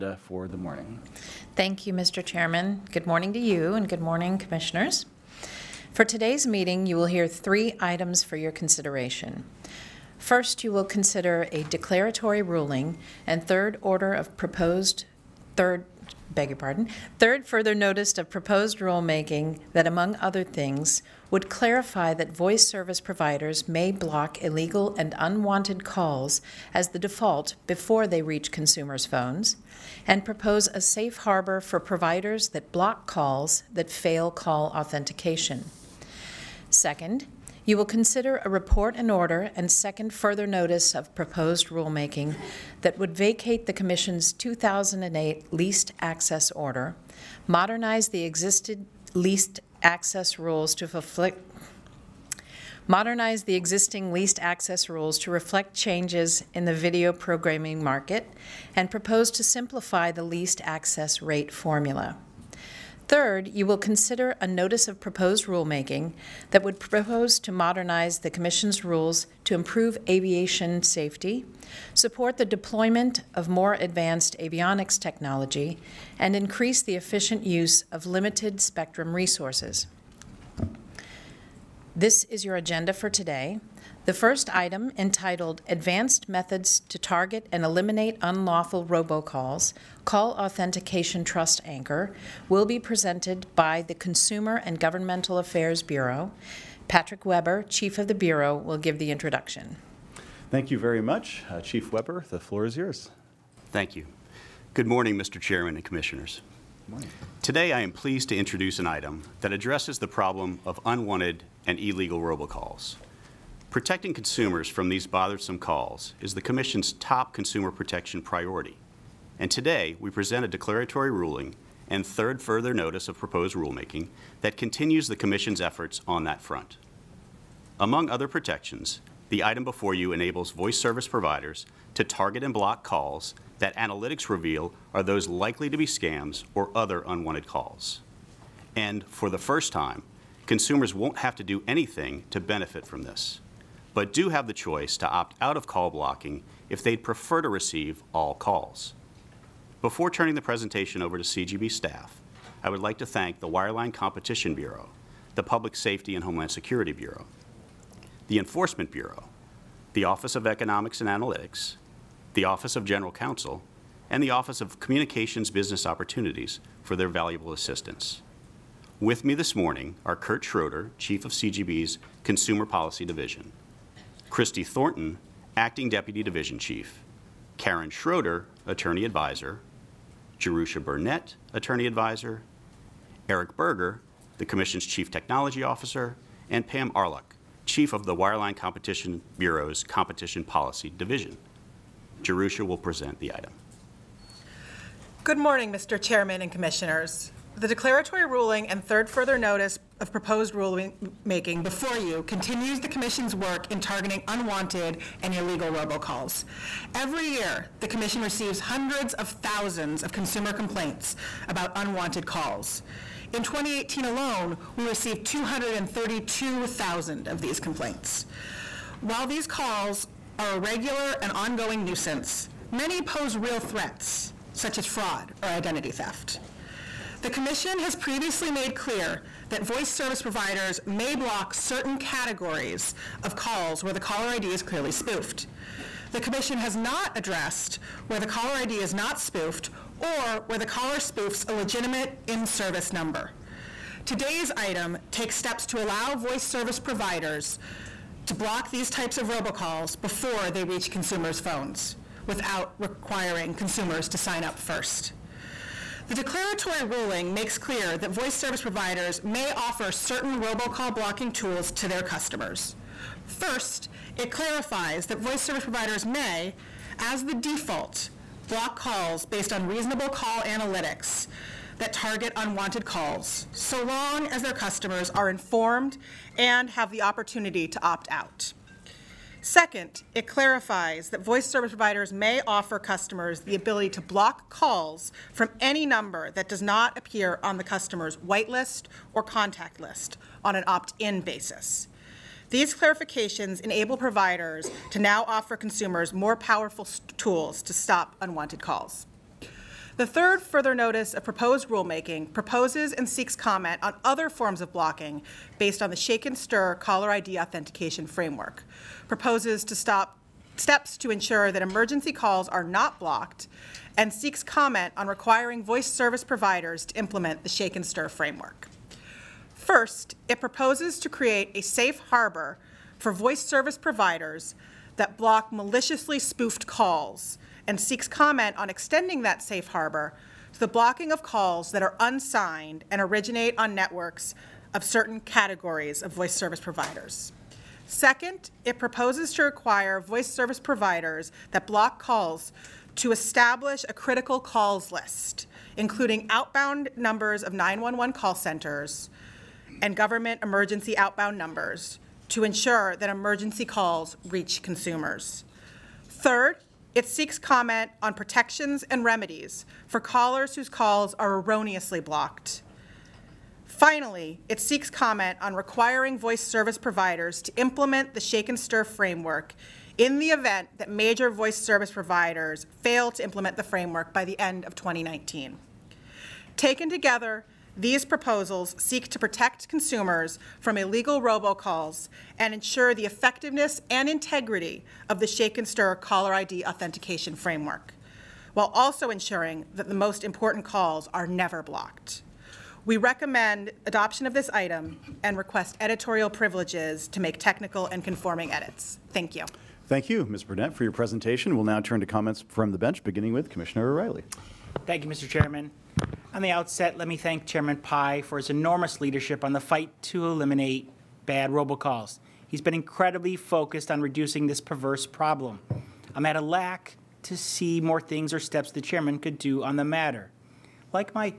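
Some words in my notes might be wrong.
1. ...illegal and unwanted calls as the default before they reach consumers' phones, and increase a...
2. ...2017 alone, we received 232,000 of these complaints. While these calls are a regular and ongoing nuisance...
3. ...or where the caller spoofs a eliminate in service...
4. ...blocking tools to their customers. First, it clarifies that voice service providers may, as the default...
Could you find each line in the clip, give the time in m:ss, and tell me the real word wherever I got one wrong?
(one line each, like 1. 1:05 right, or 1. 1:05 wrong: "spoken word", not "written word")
1. 0:24 wrong: "propose", not "increase"
2. 3:33 wrong: "2018", not "2017"
3. 4:00 wrong: "legitimate", not "eliminate"
4. 4:20 right.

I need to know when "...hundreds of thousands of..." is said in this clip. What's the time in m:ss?
3:28.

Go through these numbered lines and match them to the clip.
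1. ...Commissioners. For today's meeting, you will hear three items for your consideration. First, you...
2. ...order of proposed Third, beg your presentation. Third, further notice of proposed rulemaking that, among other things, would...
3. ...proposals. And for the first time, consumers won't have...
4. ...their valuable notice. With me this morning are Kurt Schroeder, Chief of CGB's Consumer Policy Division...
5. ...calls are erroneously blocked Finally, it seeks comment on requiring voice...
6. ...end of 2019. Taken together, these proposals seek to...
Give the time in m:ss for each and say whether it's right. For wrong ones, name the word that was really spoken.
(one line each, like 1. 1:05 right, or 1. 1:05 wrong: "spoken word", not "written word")
1. 0:04 right
2. 0:13 wrong: "pardon", not "presentation"
3. 2:17 wrong: "calls", not "proposals"
4. 2:46 wrong: "assistance", not "notice"
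5. 6:00 right
6. 6:14 right.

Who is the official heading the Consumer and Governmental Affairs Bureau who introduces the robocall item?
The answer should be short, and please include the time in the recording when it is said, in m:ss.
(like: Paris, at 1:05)
Patrick Webre, at 1:36.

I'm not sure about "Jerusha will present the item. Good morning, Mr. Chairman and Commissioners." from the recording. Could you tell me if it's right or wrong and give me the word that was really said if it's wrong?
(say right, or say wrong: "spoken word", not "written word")
right.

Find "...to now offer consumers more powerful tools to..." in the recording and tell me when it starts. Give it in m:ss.
4:54.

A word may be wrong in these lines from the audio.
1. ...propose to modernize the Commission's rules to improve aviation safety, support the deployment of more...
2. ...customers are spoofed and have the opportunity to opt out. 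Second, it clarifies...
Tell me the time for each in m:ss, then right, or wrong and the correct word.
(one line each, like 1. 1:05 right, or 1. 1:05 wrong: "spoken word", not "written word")
1. 1:06 right
2. 4:34 wrong: "informed", not "spoofed".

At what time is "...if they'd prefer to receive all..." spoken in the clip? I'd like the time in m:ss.
2:26.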